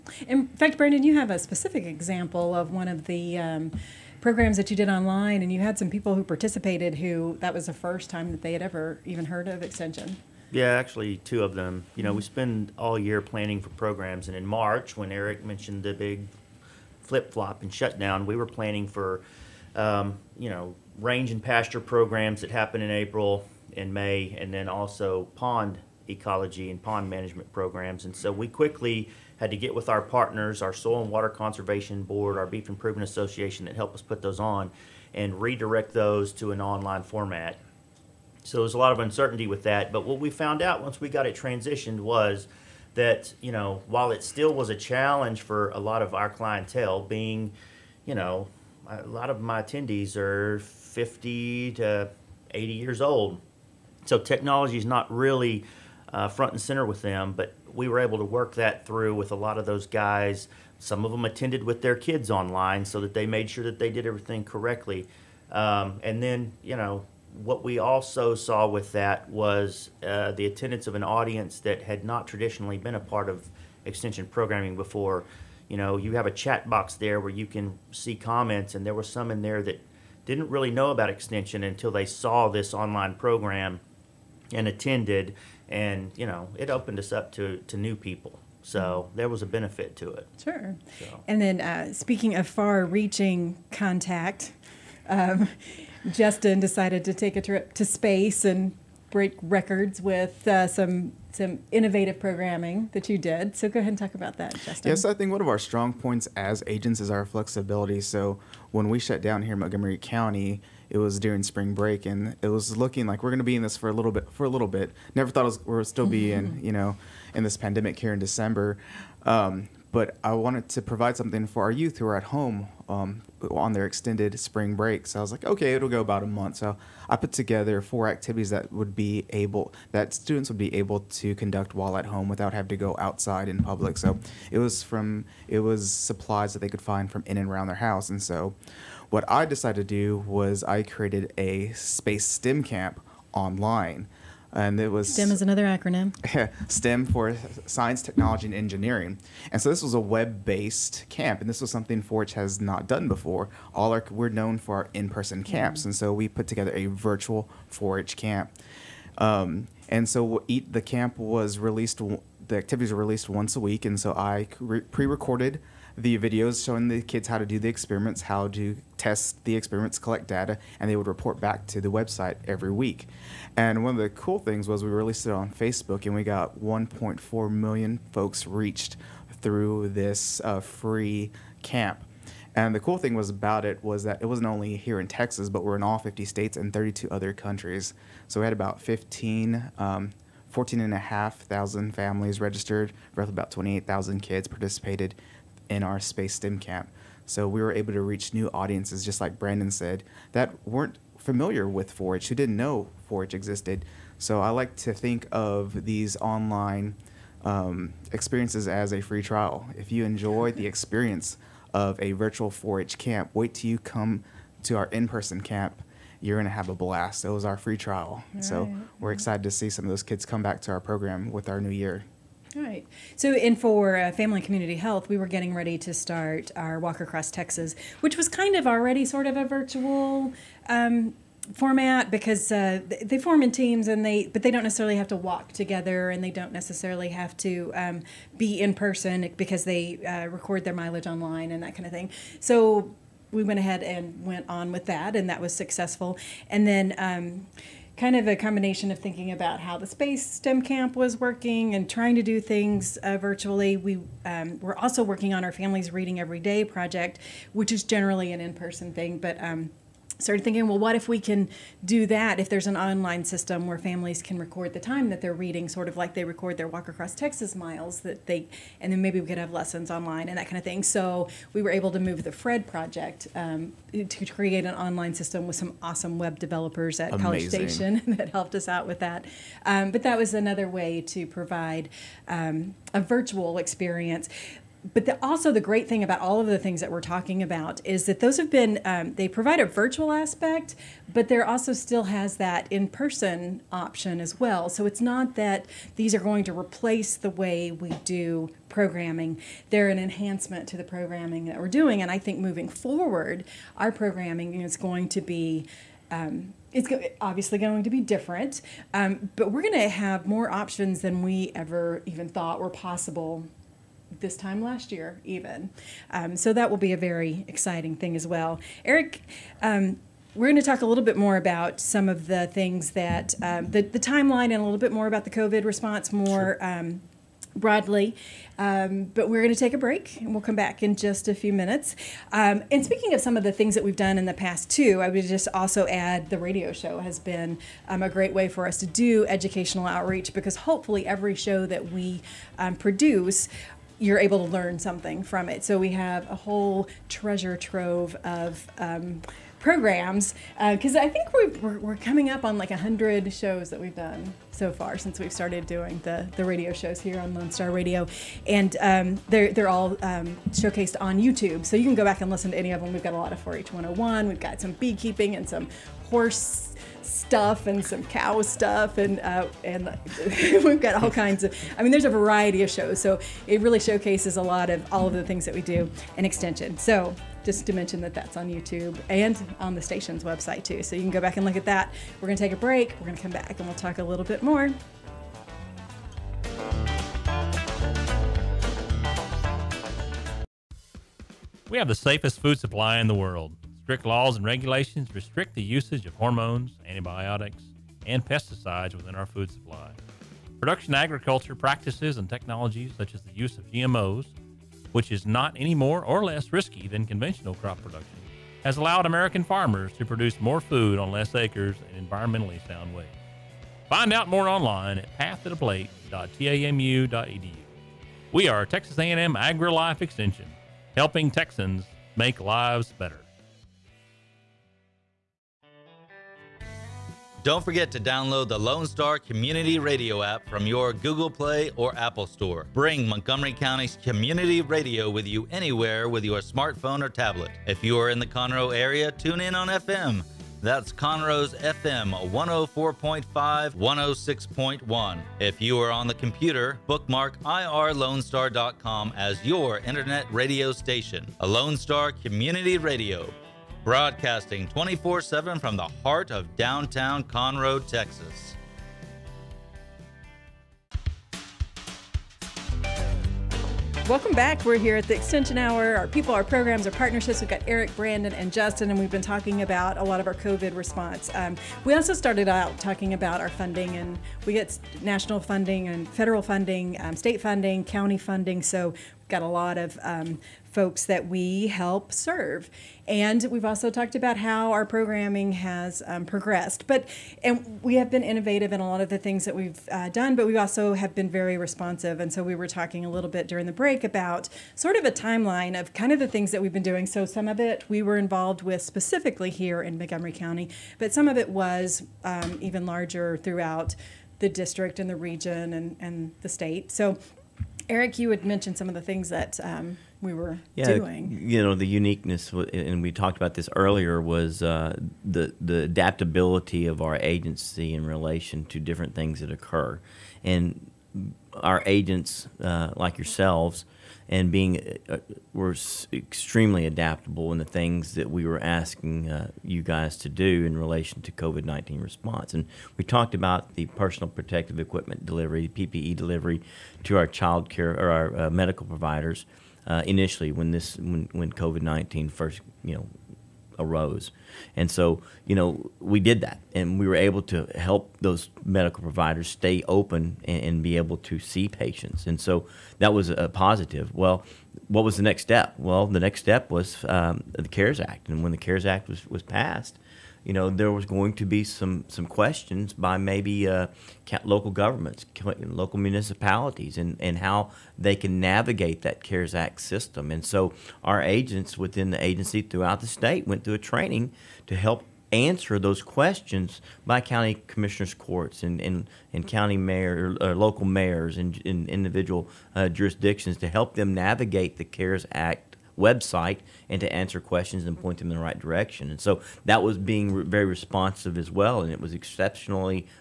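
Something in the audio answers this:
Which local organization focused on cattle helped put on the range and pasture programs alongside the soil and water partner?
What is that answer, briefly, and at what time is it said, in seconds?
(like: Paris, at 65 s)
Beef Improvement Association, at 32 s.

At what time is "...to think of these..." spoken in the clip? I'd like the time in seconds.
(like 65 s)
204 s.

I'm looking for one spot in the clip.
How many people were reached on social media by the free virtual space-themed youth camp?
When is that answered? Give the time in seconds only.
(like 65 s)
176 s.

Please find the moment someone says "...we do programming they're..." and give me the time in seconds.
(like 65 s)
297 s.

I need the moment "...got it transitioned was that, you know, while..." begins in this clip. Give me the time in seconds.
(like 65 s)
41 s.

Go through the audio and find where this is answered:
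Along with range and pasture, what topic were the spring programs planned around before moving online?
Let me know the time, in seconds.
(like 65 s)
25 s.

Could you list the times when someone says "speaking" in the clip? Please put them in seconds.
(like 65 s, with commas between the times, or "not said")
91 s, 332 s.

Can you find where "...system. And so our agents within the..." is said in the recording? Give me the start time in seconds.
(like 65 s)
569 s.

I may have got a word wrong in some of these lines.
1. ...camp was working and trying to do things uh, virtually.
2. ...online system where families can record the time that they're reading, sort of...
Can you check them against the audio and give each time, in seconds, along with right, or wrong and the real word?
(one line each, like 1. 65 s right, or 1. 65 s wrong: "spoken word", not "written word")
1. 250 s right
2. 262 s right.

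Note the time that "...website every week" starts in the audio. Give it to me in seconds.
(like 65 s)
171 s.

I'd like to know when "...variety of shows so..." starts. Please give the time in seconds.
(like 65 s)
372 s.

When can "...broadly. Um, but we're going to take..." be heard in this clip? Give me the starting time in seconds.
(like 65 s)
327 s.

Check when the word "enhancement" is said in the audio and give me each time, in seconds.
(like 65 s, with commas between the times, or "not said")
299 s.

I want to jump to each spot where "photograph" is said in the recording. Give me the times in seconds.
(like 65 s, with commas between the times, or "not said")
not said.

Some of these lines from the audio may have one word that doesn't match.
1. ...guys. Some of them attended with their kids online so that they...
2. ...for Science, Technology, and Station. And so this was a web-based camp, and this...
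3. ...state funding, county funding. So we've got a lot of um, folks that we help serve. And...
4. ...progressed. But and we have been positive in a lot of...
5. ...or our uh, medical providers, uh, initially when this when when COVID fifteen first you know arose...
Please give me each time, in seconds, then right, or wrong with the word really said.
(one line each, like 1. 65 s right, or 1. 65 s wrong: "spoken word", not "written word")
1. 59 s right
2. 147 s wrong: "Engineering", not "Station"
3. 477 s right
4. 486 s wrong: "innovative", not "positive"
5. 537 s wrong: "nineteen", not "fifteen".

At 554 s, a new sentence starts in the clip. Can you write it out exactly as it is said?
Well, what was the next step?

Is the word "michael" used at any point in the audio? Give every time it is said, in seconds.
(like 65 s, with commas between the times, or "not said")
not said.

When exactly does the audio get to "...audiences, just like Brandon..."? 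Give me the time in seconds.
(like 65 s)
198 s.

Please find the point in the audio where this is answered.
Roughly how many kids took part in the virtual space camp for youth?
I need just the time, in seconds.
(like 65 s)
193 s.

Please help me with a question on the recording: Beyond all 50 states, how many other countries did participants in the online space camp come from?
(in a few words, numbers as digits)
32.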